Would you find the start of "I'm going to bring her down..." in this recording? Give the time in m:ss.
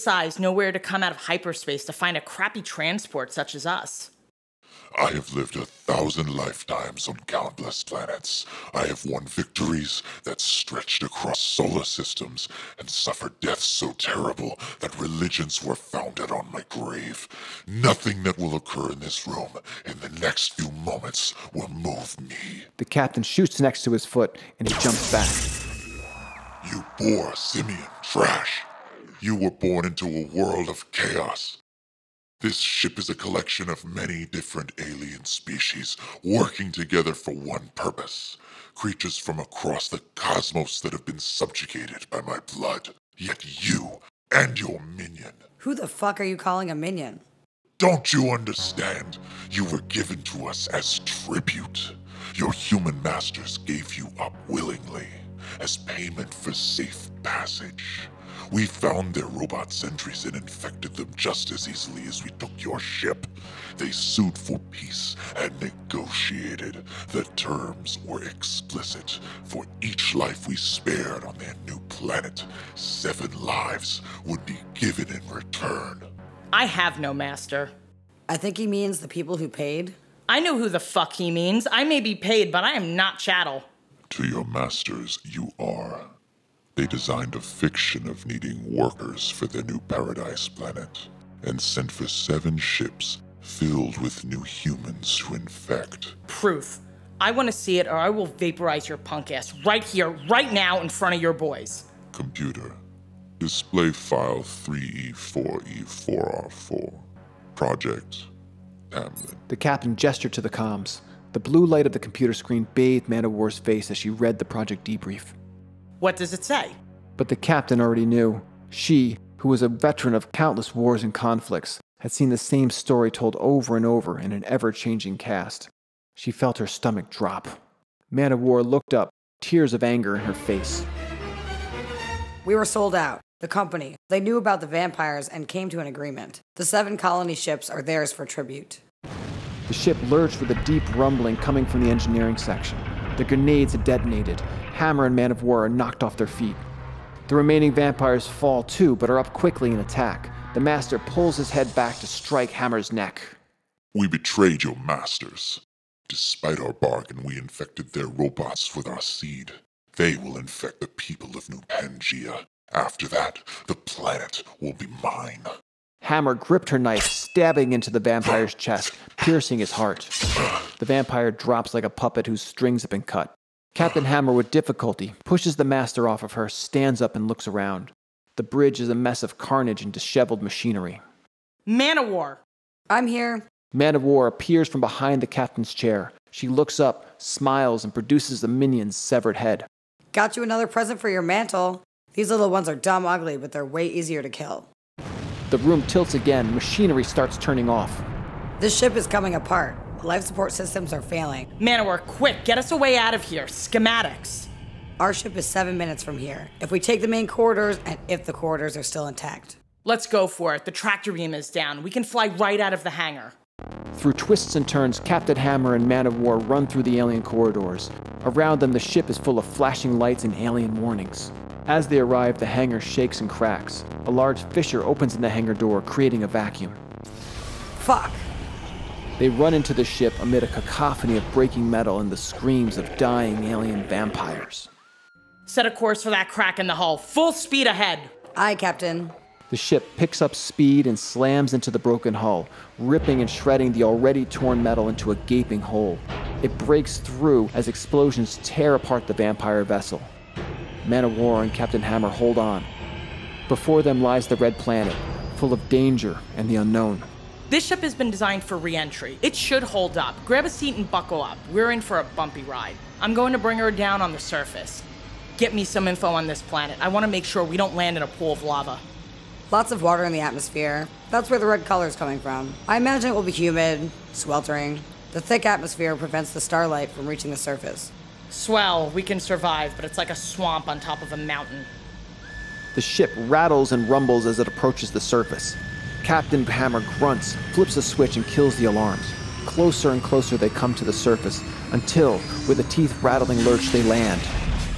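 4:22.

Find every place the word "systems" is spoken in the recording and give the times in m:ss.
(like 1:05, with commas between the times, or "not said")
0:11, 3:20.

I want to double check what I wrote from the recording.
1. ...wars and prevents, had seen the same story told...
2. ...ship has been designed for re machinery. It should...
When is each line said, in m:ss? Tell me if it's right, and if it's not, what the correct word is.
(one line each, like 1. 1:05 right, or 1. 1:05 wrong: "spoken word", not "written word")
1. 2:00 wrong: "conflicts", not "prevents"
2. 4:17 wrong: "entry", not "machinery".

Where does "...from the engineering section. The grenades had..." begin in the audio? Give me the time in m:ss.
2:21.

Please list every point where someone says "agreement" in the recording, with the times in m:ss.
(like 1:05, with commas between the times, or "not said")
2:15.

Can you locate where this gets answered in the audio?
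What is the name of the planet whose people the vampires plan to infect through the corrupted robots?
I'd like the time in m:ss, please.
2:41.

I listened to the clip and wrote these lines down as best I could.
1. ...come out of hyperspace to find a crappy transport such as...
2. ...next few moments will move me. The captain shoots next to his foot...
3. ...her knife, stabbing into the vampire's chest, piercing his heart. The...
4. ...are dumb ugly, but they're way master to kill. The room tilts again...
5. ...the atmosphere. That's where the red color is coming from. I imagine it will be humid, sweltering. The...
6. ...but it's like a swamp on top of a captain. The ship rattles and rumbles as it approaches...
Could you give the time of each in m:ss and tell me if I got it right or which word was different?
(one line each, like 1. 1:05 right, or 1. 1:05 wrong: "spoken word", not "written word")
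1. 0:00 right
2. 0:20 right
3. 2:46 right
4. 3:12 wrong: "easier", not "master"
5. 4:30 right
6. 4:39 wrong: "mountain", not "captain".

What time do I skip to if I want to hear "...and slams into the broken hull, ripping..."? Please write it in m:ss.
4:00.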